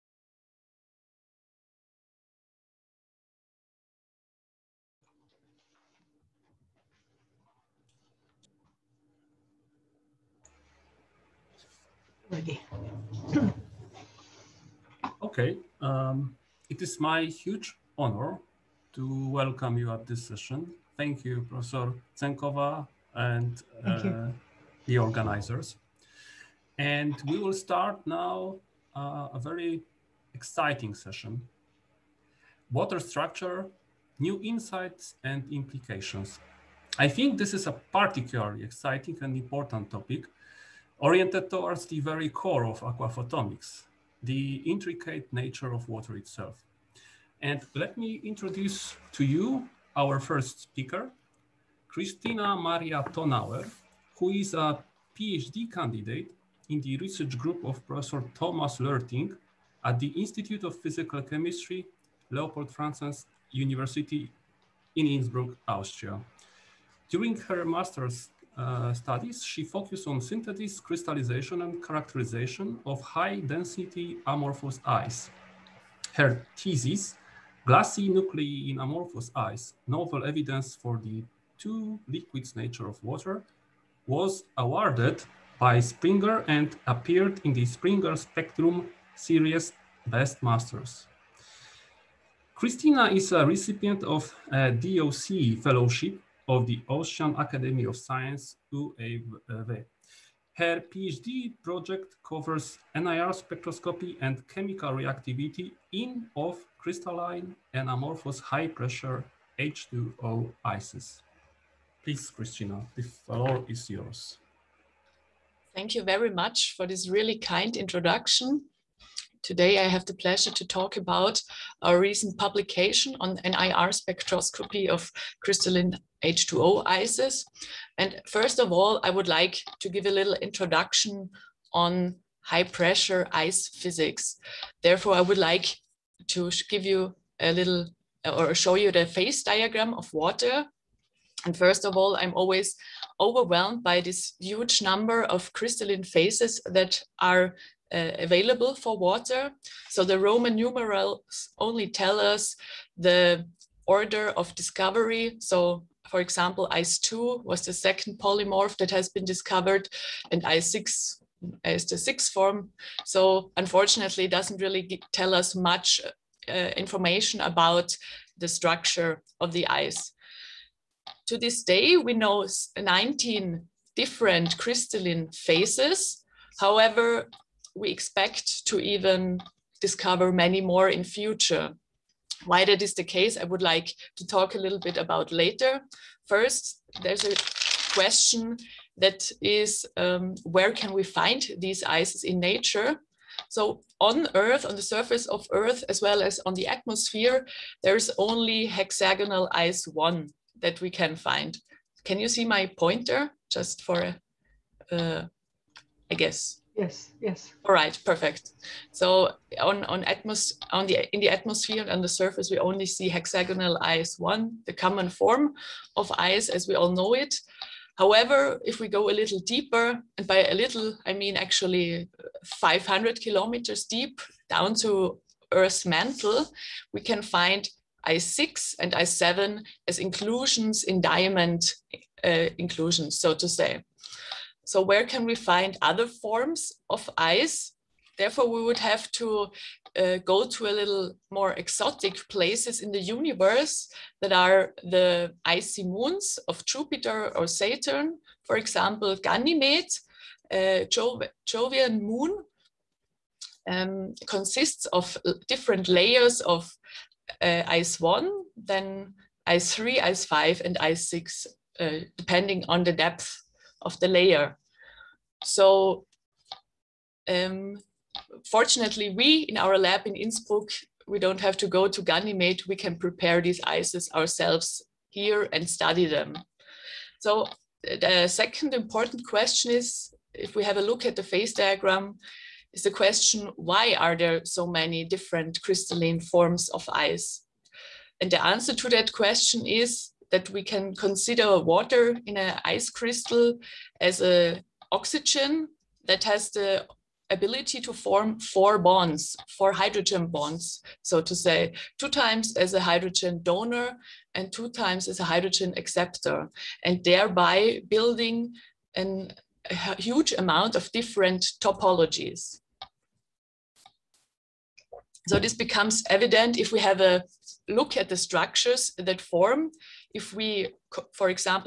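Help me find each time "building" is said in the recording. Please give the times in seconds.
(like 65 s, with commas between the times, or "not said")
307 s.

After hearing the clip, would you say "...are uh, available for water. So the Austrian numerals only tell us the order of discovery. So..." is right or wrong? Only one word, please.
wrong.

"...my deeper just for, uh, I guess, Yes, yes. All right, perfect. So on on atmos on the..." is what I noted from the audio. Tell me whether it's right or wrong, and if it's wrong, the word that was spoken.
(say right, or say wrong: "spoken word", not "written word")
wrong: "pointer", not "deeper".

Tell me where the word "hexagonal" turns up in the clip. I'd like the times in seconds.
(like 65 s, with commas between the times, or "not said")
198 s, 213 s.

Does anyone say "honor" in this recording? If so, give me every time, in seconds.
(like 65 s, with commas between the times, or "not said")
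17 s.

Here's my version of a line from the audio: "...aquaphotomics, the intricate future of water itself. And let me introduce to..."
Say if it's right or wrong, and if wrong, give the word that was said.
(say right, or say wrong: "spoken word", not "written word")
wrong: "nature", not "future".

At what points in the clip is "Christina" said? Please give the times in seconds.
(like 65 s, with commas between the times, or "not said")
51 s, 92 s, 112 s.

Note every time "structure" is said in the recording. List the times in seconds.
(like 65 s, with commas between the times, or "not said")
32 s, 168 s, 318 s.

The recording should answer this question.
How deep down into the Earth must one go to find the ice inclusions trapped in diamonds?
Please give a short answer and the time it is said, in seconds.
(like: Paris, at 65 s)
500 kilometers, at 222 s.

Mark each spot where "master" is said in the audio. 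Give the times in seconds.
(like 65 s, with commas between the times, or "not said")
67 s, 90 s.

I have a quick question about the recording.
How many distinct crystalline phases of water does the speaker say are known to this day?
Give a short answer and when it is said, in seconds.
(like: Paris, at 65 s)
19, at 172 s.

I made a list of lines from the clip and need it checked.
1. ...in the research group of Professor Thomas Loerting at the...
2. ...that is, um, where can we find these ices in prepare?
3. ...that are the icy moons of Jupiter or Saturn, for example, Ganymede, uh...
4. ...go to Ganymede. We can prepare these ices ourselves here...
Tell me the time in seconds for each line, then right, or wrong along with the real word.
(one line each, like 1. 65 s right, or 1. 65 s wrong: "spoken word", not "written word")
1. 56 s right
2. 188 s wrong: "nature", not "prepare"
3. 244 s right
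4. 271 s right.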